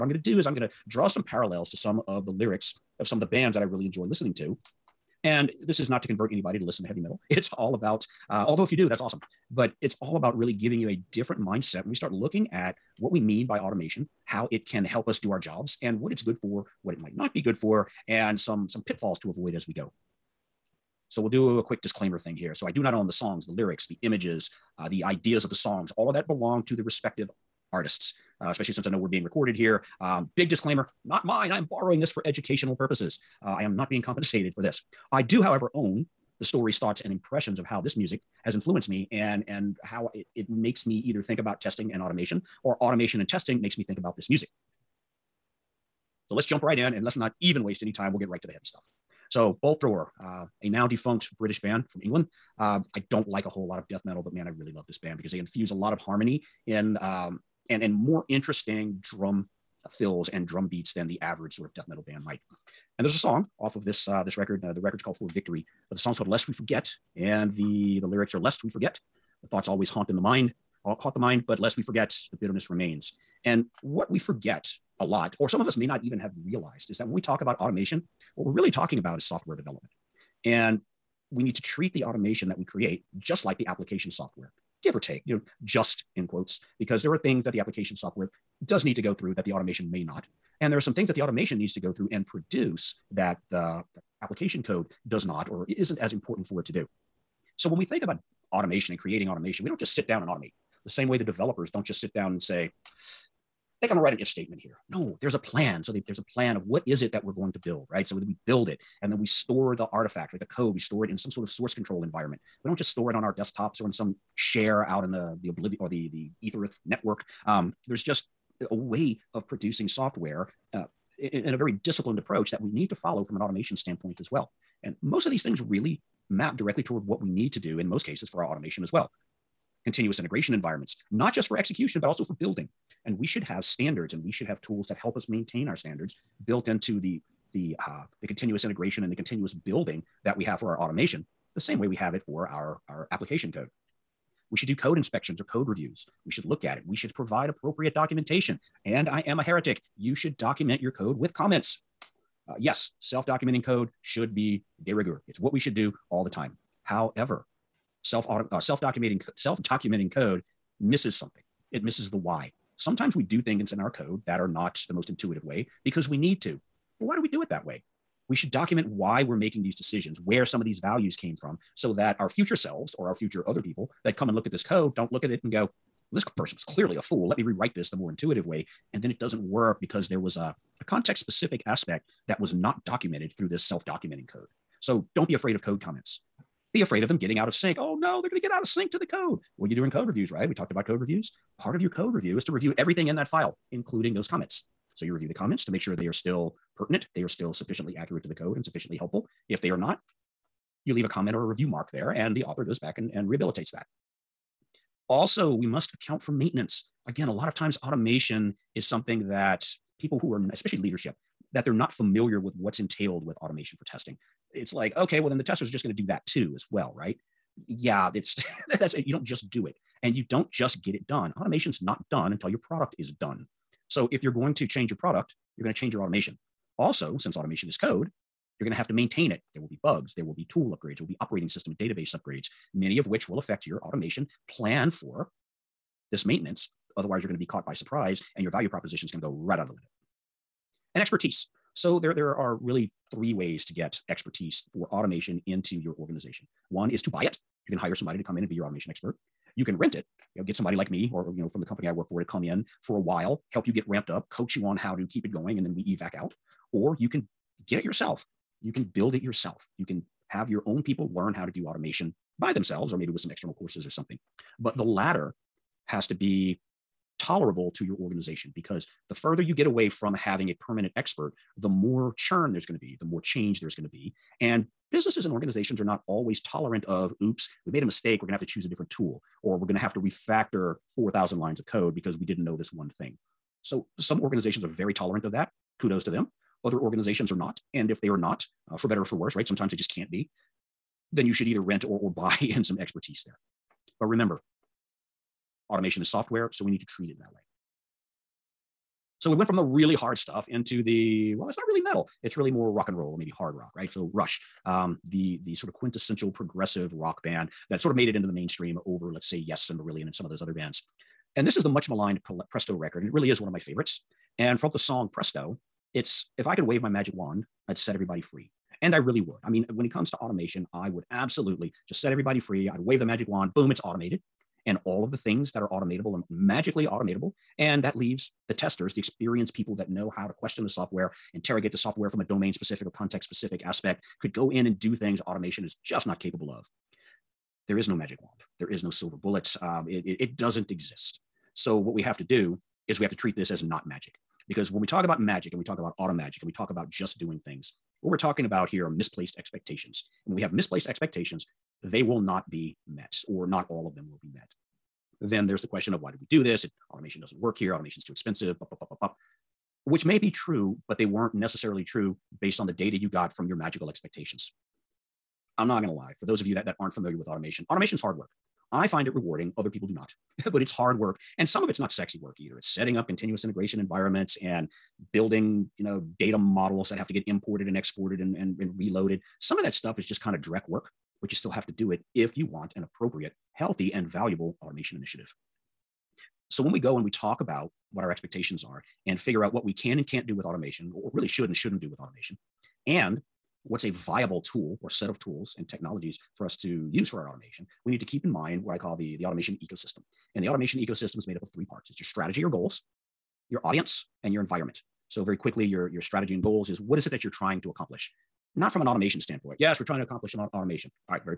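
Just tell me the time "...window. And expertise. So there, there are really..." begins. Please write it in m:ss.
3:59.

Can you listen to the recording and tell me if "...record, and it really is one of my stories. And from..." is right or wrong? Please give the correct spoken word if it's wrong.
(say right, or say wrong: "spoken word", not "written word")
wrong: "favorites", not "stories".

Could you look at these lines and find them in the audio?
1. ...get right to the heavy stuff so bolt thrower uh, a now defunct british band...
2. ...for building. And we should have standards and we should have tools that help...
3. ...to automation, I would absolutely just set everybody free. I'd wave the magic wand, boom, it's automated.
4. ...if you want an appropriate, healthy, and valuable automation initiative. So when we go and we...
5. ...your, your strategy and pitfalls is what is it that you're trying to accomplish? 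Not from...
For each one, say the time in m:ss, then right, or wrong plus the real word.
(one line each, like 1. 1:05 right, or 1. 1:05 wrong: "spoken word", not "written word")
1. 0:48 right
2. 2:12 right
3. 5:20 right
4. 6:22 right
5. 6:45 wrong: "goals", not "pitfalls".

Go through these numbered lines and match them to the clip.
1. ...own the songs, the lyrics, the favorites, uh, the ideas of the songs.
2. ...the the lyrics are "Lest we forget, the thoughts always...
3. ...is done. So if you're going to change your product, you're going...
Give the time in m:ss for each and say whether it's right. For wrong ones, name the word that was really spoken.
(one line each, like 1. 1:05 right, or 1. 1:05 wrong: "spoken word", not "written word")
1. 0:22 wrong: "images", not "favorites"
2. 1:07 right
3. 3:42 right.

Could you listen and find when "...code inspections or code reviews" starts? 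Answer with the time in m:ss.
2:24.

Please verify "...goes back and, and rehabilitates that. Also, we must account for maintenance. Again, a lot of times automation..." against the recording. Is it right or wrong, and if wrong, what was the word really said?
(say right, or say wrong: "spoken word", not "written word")
right.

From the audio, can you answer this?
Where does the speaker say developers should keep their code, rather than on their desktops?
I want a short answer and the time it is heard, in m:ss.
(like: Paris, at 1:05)
source control, at 1:51.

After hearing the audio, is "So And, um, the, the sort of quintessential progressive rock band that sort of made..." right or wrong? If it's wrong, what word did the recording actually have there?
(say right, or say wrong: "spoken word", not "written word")
wrong: "Rush", not "And".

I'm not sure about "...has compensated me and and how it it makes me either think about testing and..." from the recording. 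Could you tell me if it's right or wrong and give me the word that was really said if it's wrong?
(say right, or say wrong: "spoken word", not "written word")
wrong: "influenced", not "compensated".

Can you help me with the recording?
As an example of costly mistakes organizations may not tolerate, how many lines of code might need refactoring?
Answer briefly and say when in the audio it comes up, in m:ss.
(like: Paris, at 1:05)
4,000, at 4:40.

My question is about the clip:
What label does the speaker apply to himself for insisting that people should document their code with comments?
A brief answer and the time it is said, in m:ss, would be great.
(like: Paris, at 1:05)
heretic, at 2:29.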